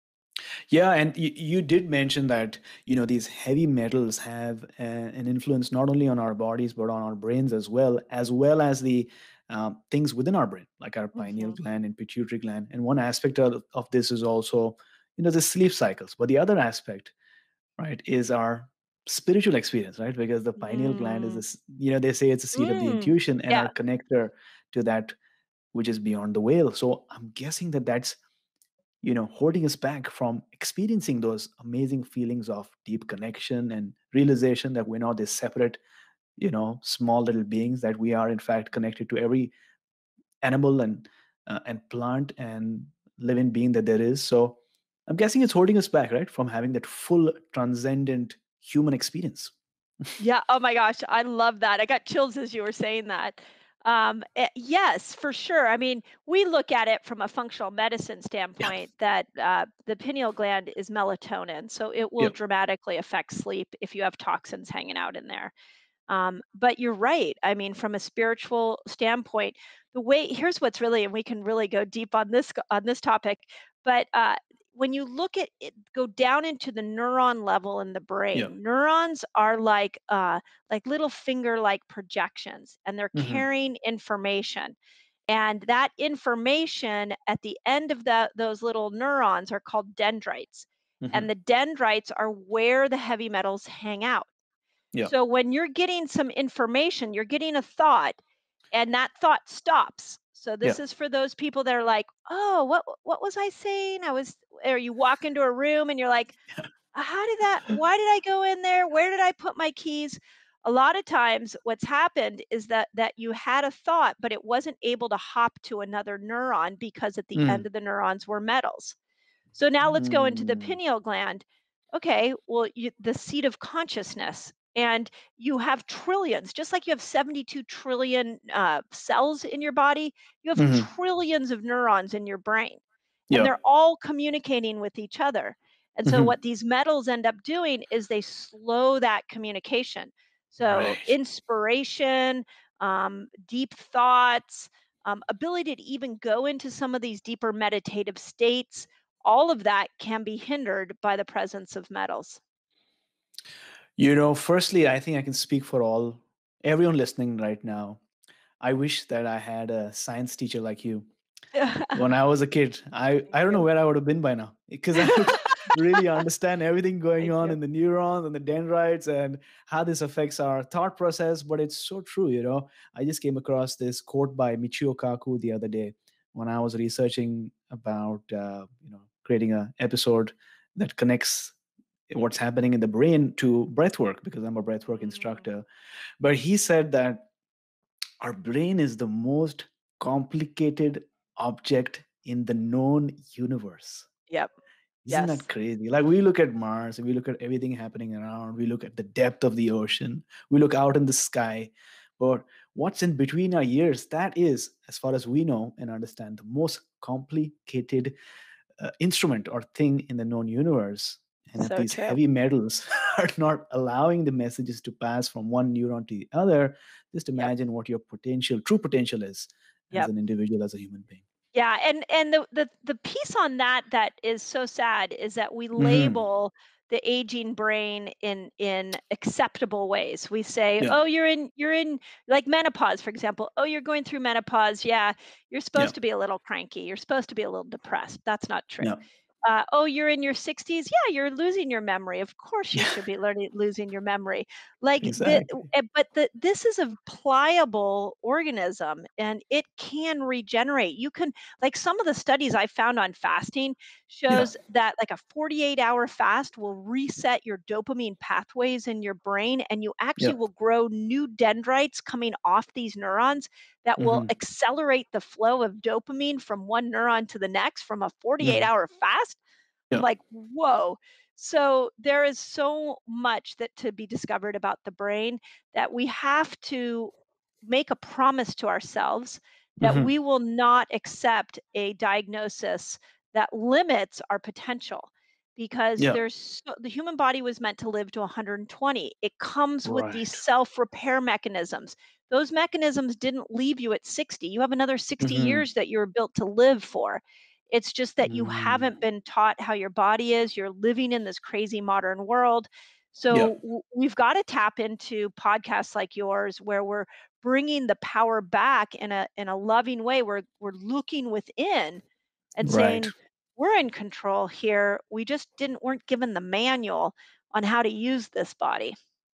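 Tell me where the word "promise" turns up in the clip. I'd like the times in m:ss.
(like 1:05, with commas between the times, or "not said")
4:37.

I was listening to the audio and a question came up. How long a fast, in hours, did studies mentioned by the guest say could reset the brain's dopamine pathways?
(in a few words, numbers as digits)
48 hours.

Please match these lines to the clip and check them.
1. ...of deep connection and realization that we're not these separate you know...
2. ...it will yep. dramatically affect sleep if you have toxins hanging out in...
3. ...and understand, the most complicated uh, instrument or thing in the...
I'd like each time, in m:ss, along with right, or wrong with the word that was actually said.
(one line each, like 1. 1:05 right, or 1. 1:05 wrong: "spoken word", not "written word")
1. 0:32 right
2. 1:01 right
3. 3:25 right.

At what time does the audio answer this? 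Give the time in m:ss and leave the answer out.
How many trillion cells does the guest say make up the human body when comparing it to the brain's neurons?
2:07.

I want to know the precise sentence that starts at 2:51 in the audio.
But it's so true, you know.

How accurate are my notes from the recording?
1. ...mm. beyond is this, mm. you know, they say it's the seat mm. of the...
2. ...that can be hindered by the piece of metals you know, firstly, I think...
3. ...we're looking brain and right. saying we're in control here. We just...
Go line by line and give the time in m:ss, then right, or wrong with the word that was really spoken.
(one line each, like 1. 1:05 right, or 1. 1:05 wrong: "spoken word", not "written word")
1. 0:20 wrong: "gland", not "beyond"
2. 2:29 wrong: "presence", not "piece"
3. 5:10 wrong: "within", not "brain".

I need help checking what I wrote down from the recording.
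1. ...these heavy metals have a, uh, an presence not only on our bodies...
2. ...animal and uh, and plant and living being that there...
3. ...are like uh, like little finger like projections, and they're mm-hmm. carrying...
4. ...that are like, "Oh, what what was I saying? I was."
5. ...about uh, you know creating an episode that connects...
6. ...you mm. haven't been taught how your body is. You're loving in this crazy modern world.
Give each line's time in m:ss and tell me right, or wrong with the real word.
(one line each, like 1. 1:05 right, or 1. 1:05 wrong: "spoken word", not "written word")
1. 0:03 wrong: "influence", not "presence"
2. 0:40 right
3. 1:19 right
4. 1:41 right
5. 2:57 right
6. 4:58 wrong: "living", not "loving".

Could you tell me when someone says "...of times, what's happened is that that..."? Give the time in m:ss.
1:50.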